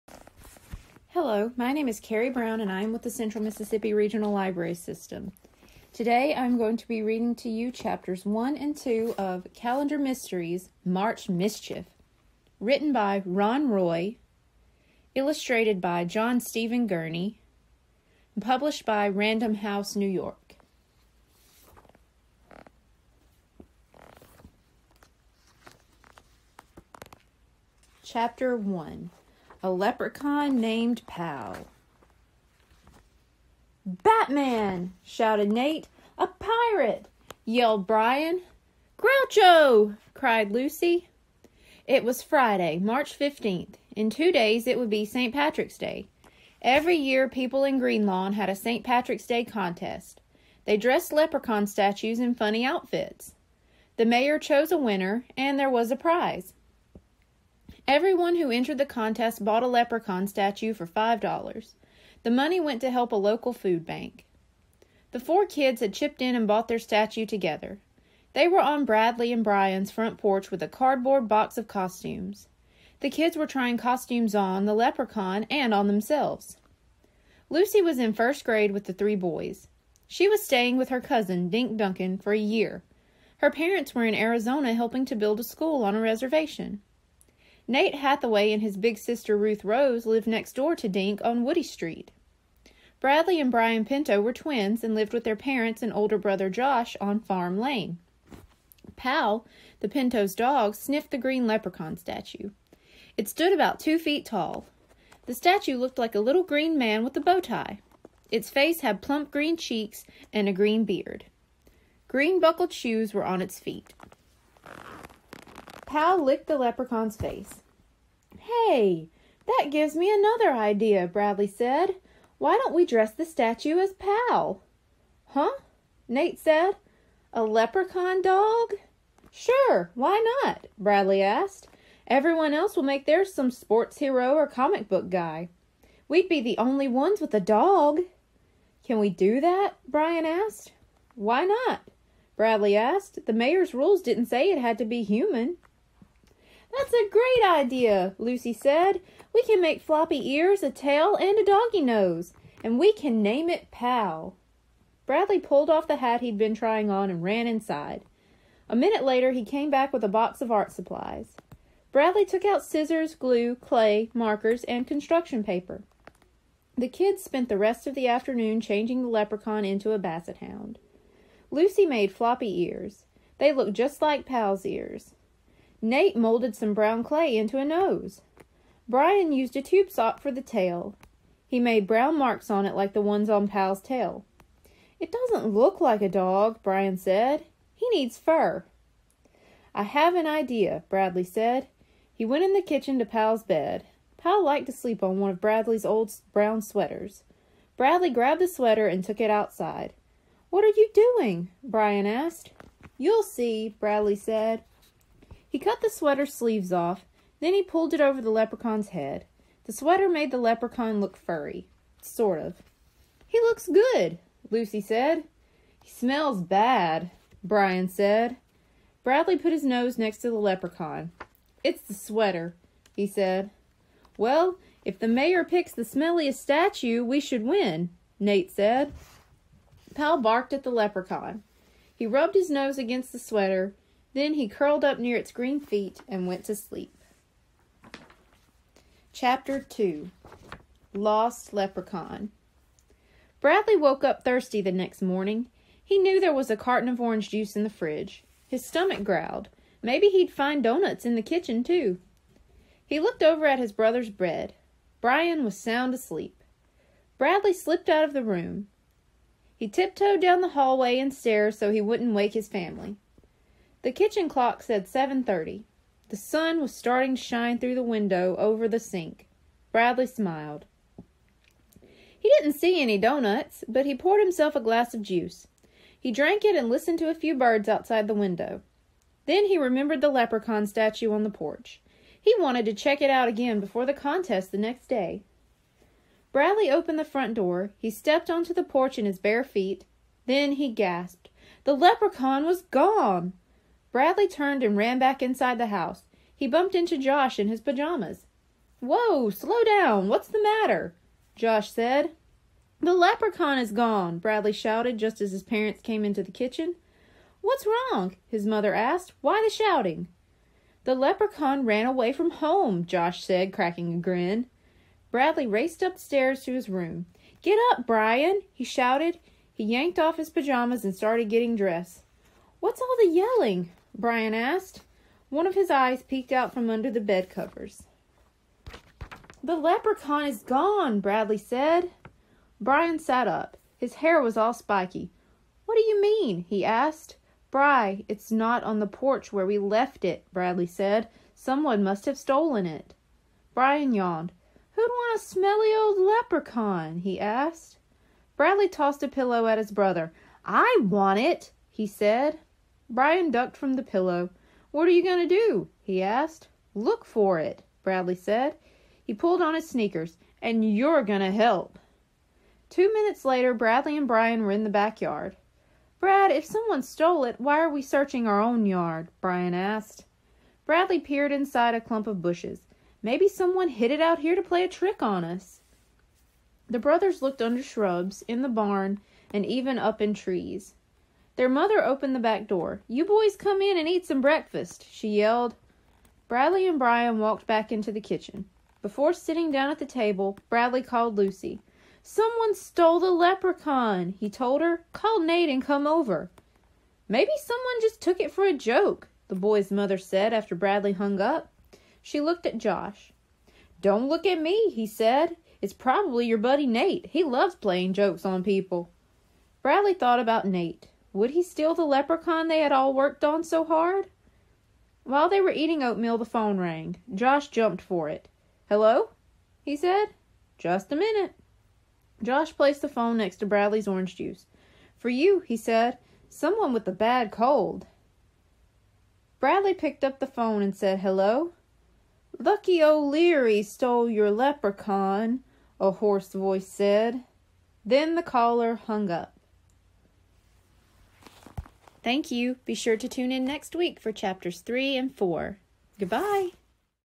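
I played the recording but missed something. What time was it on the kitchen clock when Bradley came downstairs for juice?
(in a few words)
7:30.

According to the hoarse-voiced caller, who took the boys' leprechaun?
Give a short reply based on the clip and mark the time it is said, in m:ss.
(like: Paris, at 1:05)
Lucky O'Leary, at 7:12.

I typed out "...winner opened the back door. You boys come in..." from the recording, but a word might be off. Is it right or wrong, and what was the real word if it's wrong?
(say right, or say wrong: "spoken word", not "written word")
wrong: "mother", not "winner".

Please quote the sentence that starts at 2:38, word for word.
A minute later, he came back with a box of art supplies.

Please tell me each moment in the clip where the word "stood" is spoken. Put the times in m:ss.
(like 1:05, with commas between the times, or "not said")
1:43.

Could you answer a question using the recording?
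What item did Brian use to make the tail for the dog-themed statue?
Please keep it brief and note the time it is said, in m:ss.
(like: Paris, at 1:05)
tube sock, at 2:59.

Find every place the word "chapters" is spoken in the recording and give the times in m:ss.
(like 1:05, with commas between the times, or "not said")
0:07, 0:28, 3:59, 7:24.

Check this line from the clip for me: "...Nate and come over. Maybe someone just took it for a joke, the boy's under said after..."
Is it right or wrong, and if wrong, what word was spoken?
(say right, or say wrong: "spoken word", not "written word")
wrong: "mother", not "under".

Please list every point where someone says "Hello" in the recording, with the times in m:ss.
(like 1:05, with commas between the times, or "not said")
0:01, 6:58, 7:10.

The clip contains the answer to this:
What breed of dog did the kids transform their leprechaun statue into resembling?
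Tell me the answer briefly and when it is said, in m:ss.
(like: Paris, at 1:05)
basset hound, at 2:49.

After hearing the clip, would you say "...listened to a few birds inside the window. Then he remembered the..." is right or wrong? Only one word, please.
wrong.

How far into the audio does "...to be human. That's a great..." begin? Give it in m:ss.
2:24.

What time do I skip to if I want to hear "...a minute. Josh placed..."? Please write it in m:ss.
7:00.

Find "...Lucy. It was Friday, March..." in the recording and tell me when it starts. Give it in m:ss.
0:40.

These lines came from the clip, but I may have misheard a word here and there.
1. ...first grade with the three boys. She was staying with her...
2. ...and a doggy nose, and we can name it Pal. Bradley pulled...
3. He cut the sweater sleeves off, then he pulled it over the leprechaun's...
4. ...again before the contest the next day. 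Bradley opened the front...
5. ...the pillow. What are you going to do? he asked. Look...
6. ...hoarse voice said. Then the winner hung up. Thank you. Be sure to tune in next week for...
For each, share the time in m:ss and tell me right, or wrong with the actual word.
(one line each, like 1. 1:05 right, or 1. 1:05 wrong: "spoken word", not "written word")
1. 1:18 right
2. 2:31 right
3. 3:25 right
4. 4:43 right
5. 5:53 right
6. 7:15 wrong: "caller", not "winner".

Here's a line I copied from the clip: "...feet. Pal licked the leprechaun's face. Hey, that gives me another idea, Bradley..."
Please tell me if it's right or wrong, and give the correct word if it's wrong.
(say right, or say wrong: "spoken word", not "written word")
right.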